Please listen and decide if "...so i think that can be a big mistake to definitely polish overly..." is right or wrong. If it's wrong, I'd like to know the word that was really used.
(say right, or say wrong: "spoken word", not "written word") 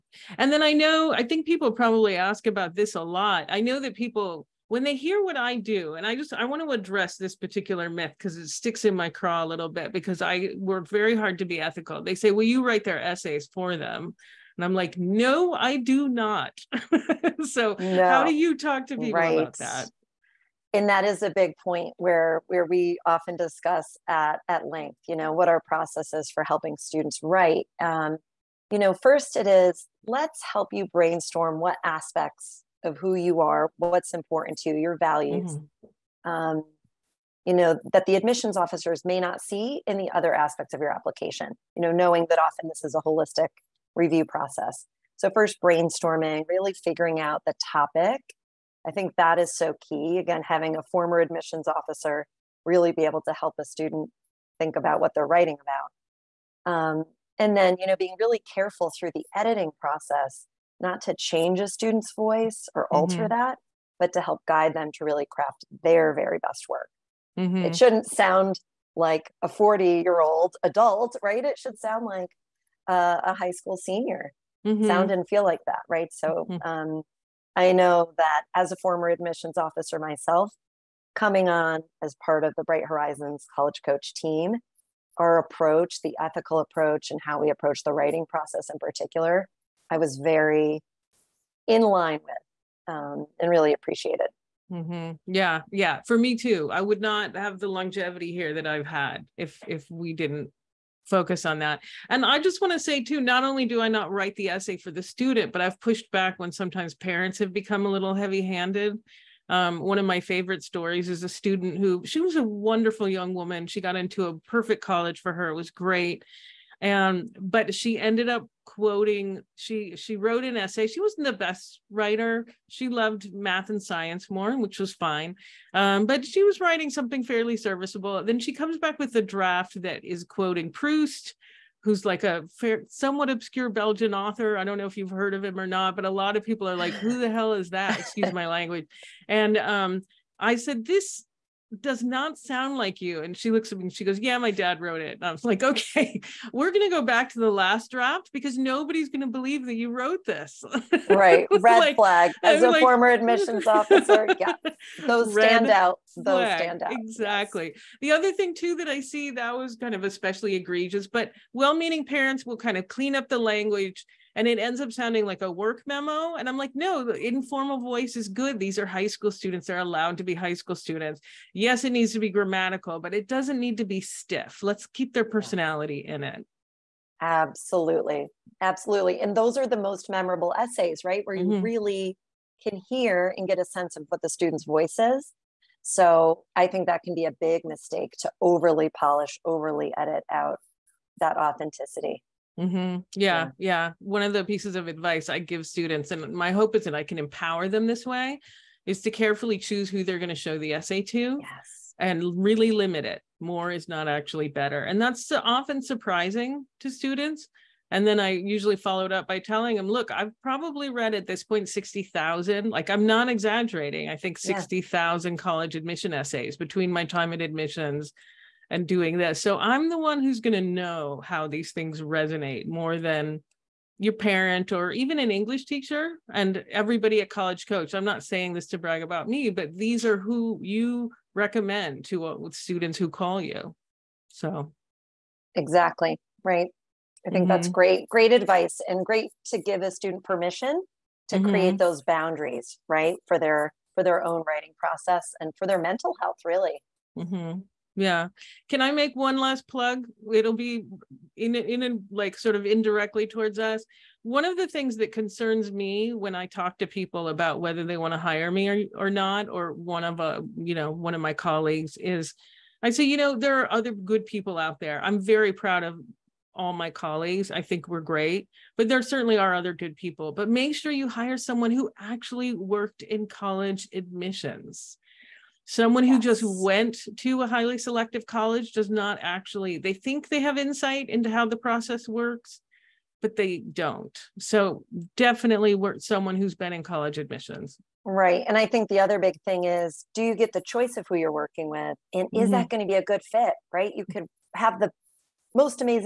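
wrong: "overly", not "definitely".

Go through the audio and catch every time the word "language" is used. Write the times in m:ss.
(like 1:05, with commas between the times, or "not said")
2:18, 2:43.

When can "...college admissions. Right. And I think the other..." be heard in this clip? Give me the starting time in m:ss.
4:46.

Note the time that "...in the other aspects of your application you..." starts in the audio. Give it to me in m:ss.
0:39.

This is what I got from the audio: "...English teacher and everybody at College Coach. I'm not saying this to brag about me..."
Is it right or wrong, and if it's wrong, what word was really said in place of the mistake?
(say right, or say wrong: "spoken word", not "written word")
right.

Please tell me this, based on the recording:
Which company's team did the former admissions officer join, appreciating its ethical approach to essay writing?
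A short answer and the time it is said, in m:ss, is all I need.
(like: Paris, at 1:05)
Bright Horizons College Coach, at 1:22.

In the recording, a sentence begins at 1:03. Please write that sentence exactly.
that, but to help guide them to really craft their very best work.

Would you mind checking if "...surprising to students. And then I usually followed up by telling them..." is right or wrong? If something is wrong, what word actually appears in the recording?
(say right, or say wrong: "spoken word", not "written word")
right.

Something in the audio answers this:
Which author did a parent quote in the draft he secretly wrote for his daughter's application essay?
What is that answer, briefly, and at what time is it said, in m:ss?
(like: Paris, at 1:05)
Proust, at 2:10.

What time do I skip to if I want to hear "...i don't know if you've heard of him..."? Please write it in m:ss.
2:14.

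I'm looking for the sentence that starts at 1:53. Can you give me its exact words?
She got into a perfect college for her.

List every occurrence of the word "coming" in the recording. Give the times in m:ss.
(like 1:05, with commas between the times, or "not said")
1:21.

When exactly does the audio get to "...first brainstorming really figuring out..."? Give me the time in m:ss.
0:45.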